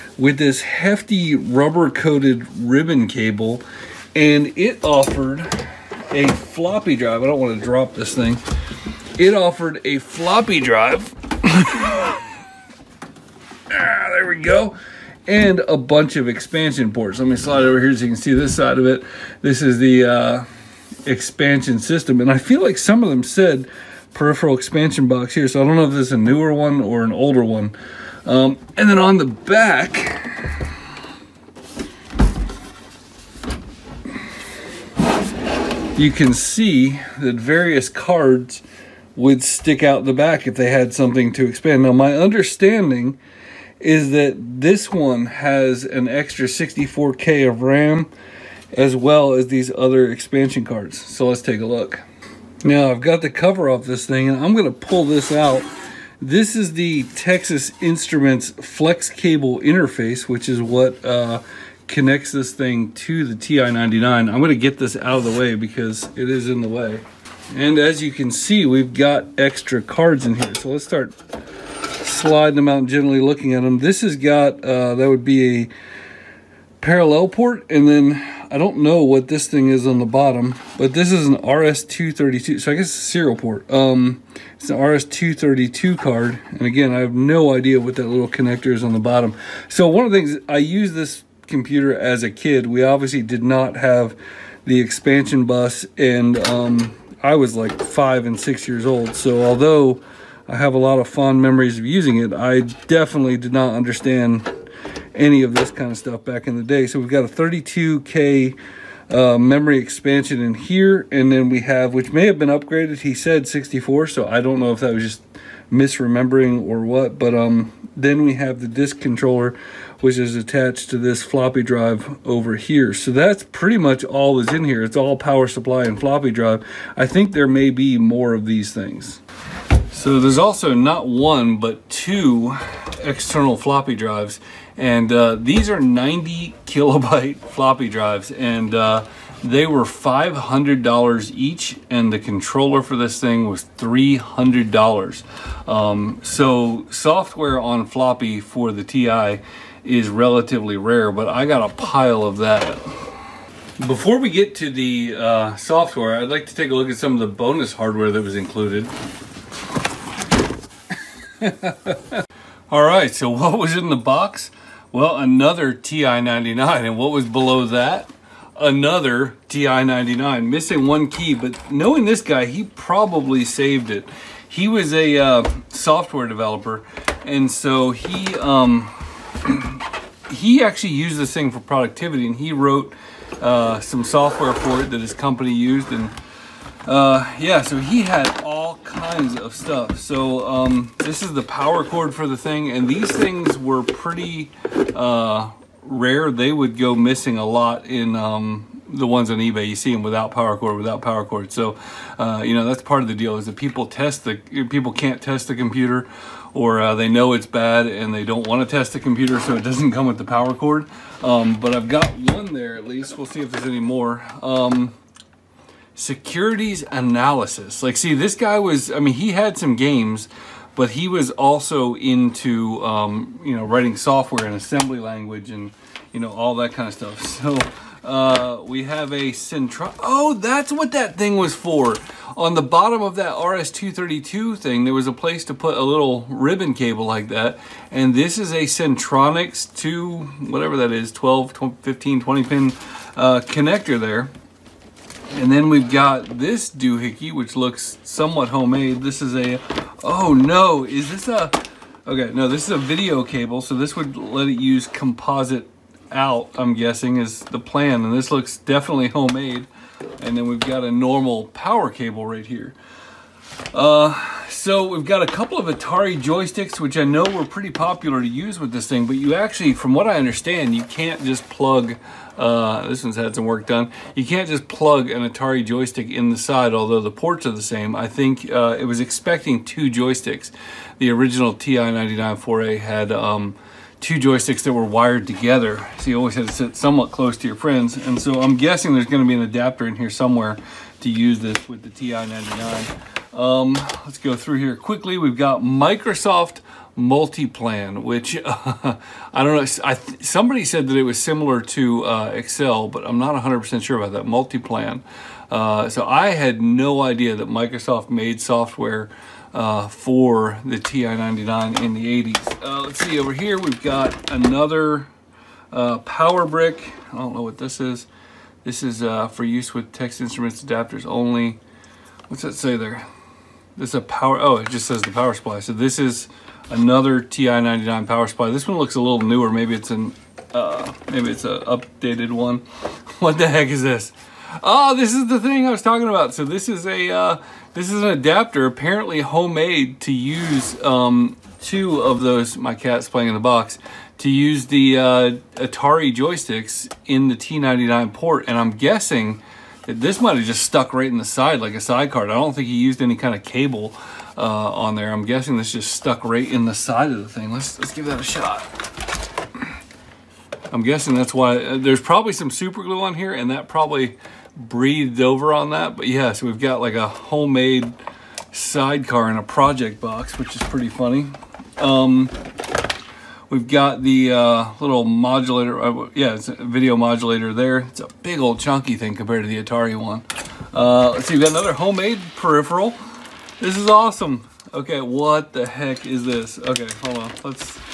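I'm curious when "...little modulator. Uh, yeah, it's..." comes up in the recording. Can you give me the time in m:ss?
6:14.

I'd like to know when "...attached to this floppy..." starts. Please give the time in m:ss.
2:00.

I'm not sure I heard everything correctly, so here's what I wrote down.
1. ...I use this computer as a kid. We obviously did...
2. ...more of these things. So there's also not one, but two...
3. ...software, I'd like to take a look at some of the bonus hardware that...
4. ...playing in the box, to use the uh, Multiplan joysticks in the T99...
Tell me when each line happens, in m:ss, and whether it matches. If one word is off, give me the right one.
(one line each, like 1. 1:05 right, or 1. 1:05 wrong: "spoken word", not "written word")
1. 1:30 right
2. 2:07 right
3. 2:35 right
4. 5:43 wrong: "Atari", not "Multiplan".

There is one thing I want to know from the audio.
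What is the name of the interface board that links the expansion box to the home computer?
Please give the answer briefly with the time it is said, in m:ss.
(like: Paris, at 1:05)
Texas Instruments flex cable interface, at 0:57.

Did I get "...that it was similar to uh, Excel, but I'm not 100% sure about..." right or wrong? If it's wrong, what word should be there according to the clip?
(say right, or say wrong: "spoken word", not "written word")
right.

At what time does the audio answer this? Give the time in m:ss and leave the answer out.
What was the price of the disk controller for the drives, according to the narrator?
2:23.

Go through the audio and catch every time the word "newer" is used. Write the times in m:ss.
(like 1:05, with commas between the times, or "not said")
0:26, 5:29.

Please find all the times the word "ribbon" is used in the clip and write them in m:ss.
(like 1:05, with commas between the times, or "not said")
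0:02, 3:56.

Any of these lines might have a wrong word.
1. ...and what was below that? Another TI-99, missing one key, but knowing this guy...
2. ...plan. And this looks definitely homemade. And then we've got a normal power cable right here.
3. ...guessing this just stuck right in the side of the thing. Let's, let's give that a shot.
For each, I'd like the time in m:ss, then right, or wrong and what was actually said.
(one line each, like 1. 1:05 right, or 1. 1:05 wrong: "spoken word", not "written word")
1. 2:46 right
2. 4:17 right
3. 5:55 right.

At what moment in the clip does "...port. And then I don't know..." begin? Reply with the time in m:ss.
1:17.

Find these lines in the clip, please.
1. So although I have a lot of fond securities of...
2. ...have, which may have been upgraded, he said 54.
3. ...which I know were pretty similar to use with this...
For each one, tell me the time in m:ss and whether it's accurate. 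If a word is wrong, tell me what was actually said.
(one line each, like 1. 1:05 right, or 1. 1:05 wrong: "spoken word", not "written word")
1. 1:39 wrong: "memories", not "securities"
2. 1:51 wrong: "64", not "54"
3. 4:26 wrong: "popular", not "similar".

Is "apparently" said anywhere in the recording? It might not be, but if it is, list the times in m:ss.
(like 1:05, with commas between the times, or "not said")
5:38.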